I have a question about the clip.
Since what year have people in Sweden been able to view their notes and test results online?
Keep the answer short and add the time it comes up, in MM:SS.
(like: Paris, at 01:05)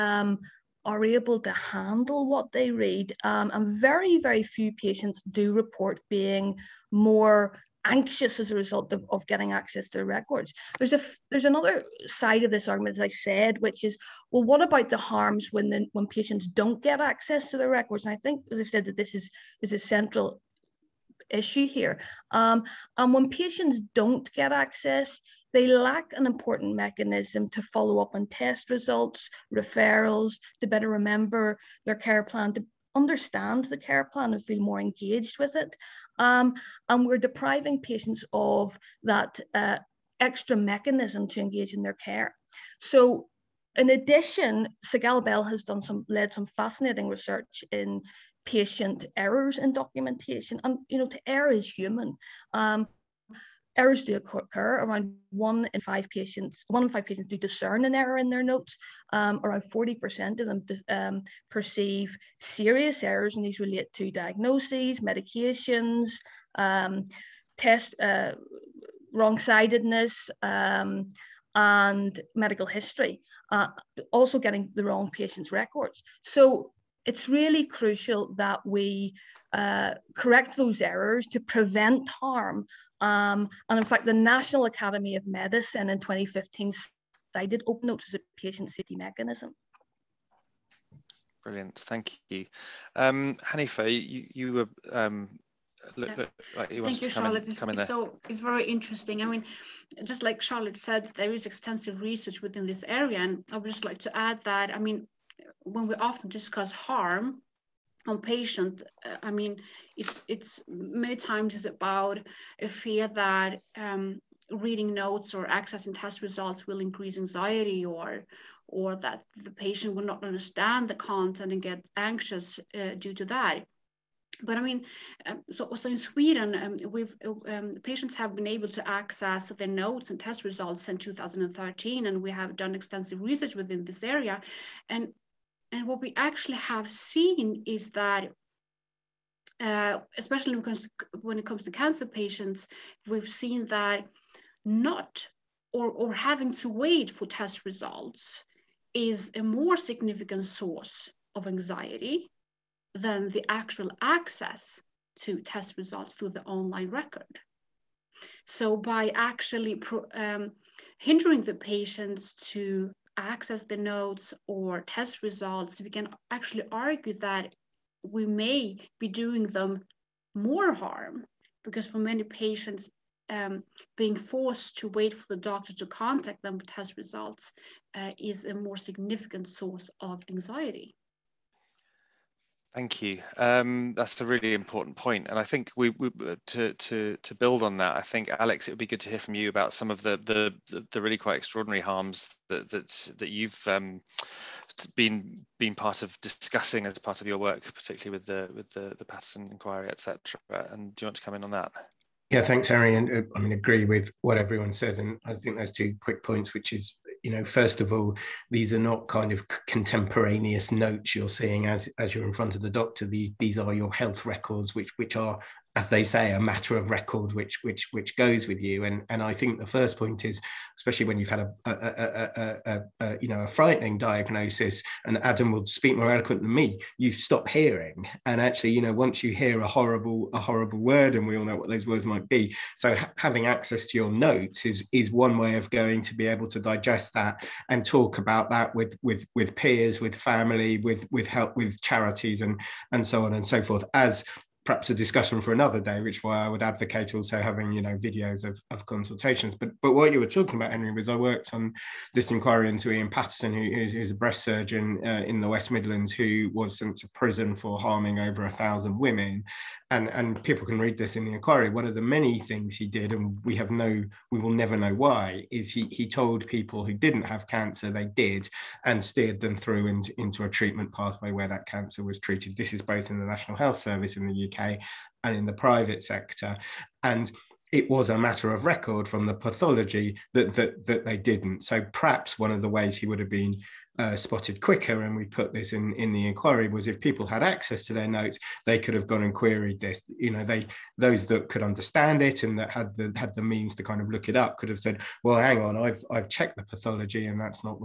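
2013, at 02:11.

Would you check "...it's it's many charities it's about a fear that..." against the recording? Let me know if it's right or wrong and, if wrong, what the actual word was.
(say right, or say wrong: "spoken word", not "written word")
wrong: "times", not "charities".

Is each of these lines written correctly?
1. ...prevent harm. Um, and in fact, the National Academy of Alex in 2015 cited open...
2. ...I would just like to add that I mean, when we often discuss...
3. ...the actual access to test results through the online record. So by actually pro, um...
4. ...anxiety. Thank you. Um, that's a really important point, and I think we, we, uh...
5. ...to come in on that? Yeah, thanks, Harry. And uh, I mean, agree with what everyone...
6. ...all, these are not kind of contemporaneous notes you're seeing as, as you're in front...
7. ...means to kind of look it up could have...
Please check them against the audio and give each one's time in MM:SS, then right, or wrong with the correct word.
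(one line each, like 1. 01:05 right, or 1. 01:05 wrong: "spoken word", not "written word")
1. 01:21 wrong: "Medicine", not "Alex"
2. 01:43 right
3. 02:33 right
4. 03:00 right
5. 03:21 right
6. 03:27 right
7. 04:53 right.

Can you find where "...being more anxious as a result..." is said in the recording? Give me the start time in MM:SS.
00:06.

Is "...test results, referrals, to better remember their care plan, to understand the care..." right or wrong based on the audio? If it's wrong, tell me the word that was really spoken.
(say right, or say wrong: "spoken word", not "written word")
right.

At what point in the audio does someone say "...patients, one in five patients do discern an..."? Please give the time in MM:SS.
00:56.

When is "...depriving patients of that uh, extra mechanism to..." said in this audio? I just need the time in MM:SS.
00:37.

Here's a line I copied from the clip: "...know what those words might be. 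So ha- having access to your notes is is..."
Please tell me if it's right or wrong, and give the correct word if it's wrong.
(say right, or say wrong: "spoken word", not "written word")
right.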